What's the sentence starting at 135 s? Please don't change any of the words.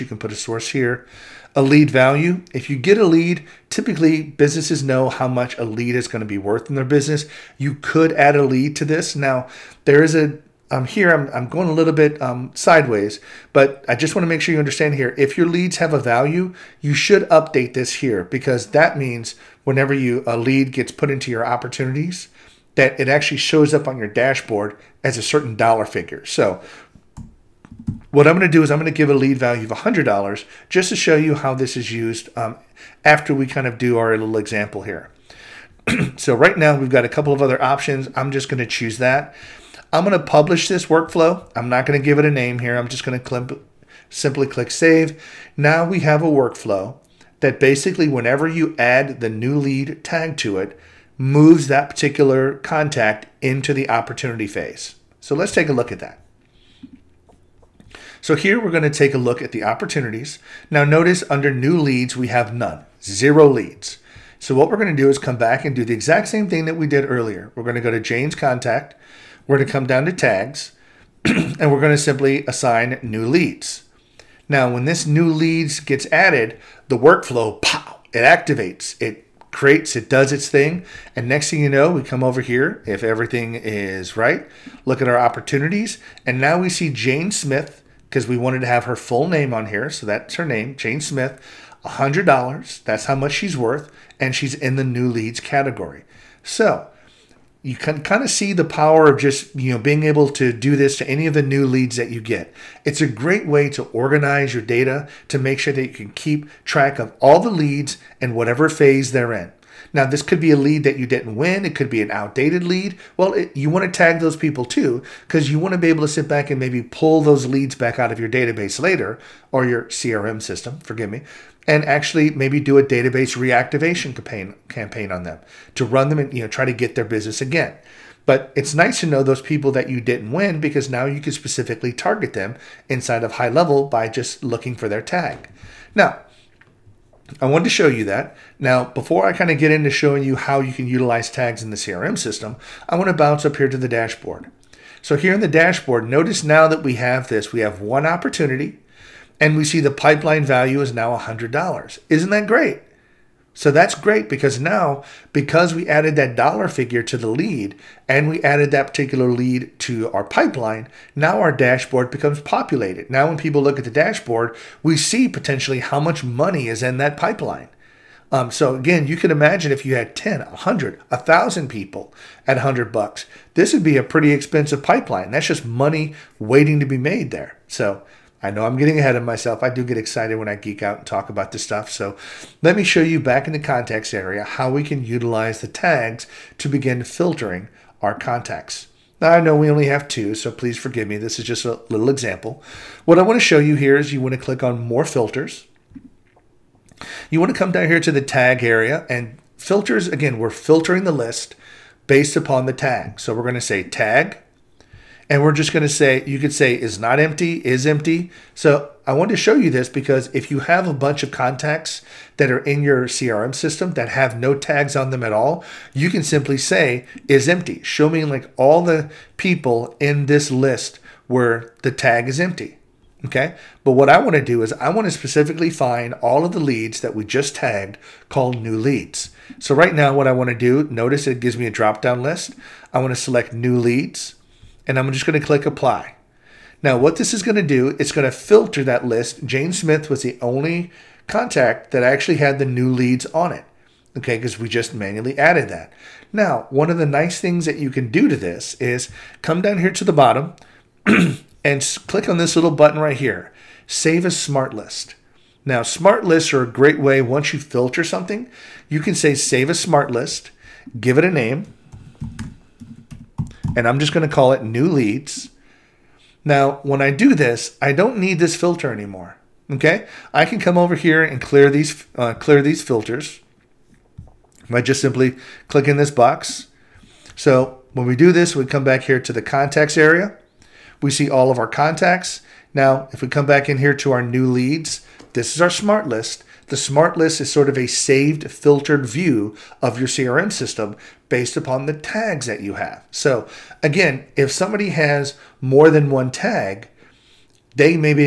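Now, I wanted to show you that.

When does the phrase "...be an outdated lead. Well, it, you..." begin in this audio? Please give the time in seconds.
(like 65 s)
111 s.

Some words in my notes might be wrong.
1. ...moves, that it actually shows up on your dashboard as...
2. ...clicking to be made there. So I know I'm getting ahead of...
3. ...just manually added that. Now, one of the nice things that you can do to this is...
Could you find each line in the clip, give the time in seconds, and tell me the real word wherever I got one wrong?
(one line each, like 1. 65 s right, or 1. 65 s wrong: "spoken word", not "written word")
1. 21 s wrong: "opportunities", not "moves"
2. 176 s wrong: "waiting", not "clicking"
3. 244 s right.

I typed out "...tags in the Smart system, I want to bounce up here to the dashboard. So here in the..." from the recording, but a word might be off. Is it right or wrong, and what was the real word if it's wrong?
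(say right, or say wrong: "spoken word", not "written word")
wrong: "CRM", not "Smart".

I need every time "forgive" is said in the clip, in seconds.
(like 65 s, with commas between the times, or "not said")
120 s, 190 s.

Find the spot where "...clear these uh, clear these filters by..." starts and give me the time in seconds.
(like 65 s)
271 s.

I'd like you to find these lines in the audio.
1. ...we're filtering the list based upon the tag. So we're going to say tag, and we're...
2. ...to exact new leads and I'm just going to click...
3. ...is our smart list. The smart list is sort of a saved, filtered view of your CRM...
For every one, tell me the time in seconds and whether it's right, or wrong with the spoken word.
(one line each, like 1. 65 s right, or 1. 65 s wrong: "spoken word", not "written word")
1. 200 s right
2. 233 s wrong: "select", not "exact"
3. 285 s right.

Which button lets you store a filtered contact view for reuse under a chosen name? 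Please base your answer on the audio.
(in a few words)
Save as Smart List.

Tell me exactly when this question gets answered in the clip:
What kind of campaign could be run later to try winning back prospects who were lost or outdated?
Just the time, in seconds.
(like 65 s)
122 s.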